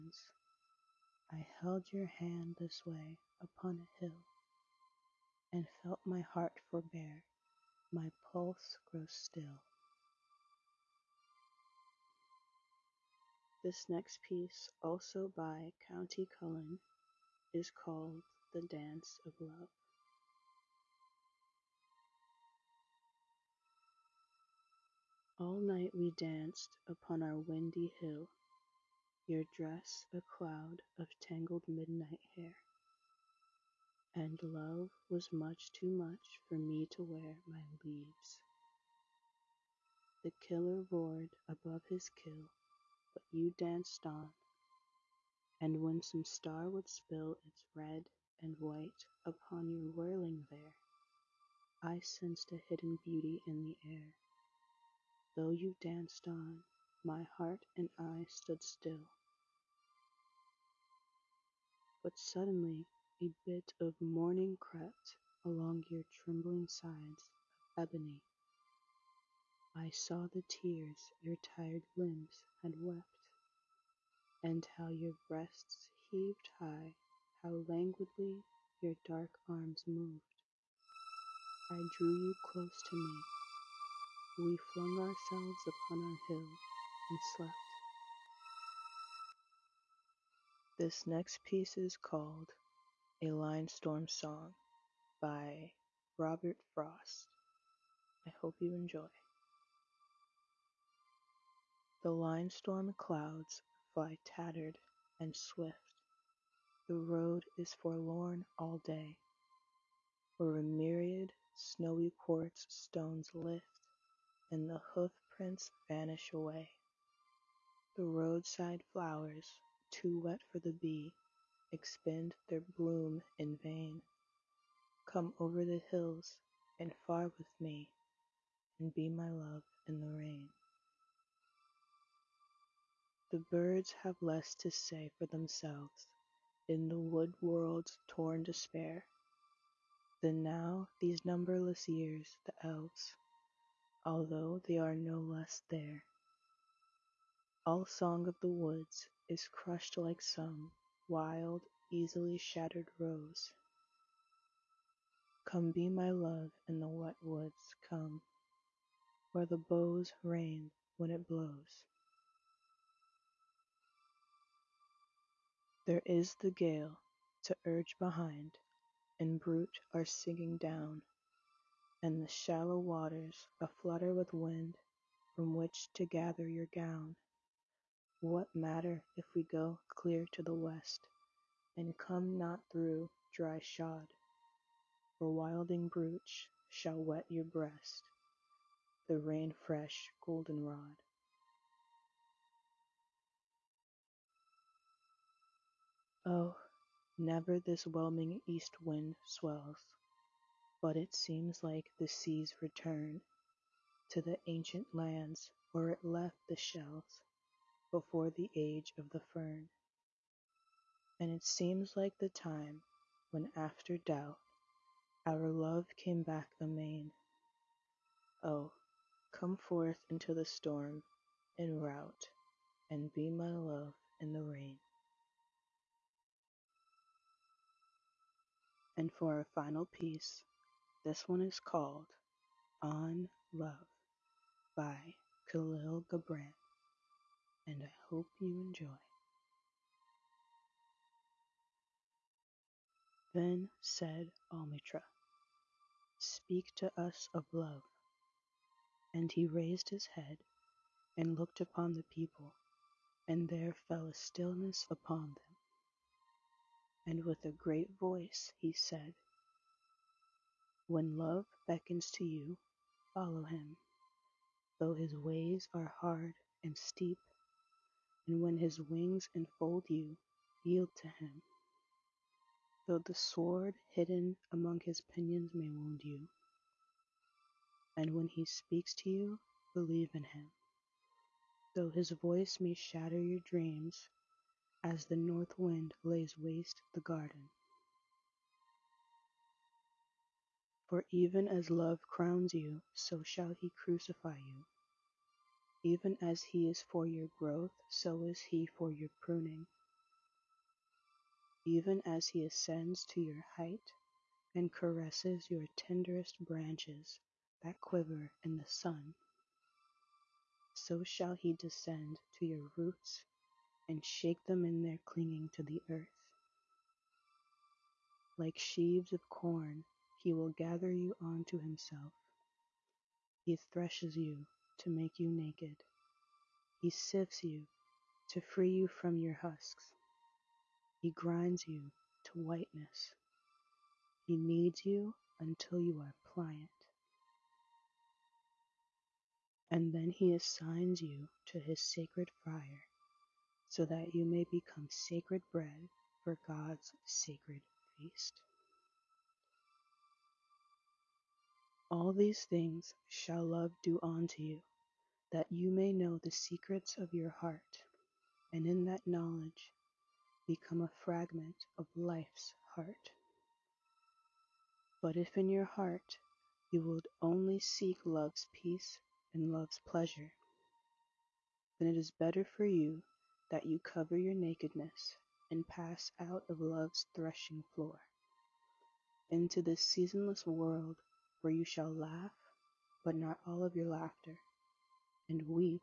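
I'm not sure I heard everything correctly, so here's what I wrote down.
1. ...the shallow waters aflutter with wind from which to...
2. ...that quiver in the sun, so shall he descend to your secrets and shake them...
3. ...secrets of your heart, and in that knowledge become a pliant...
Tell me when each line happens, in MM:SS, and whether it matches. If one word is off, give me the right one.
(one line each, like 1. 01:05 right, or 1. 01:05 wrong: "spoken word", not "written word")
1. 02:52 right
2. 05:07 wrong: "roots", not "secrets"
3. 05:56 wrong: "fragment", not "pliant".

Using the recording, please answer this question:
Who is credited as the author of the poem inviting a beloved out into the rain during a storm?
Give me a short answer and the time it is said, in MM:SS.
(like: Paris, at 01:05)
Robert Frost, at 01:36.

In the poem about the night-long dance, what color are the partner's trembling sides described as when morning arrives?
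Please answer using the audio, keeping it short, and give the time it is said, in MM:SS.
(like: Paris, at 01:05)
ebony, at 01:07.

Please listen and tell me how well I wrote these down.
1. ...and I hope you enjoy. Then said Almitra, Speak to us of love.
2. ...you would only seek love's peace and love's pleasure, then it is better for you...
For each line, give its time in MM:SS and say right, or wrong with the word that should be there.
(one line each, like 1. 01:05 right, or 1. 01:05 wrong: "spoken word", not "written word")
1. 03:57 right
2. 06:06 right.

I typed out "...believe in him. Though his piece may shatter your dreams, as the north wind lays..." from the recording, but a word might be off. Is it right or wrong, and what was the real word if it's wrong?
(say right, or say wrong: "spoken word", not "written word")
wrong: "voice", not "piece".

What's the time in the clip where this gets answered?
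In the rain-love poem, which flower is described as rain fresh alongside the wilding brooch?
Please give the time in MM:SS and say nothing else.
03:10.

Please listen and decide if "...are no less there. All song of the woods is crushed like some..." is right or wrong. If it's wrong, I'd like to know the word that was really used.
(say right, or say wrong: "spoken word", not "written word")
right.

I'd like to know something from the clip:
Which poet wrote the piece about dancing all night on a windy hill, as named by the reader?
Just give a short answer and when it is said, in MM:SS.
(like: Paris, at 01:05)
Countee Cullen, at 00:15.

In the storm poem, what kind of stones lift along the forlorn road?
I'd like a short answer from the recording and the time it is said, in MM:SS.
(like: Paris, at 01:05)
snowy quartz stones, at 01:51.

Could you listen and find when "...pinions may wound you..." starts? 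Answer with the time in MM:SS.
04:35.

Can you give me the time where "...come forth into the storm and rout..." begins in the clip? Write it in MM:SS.
03:39.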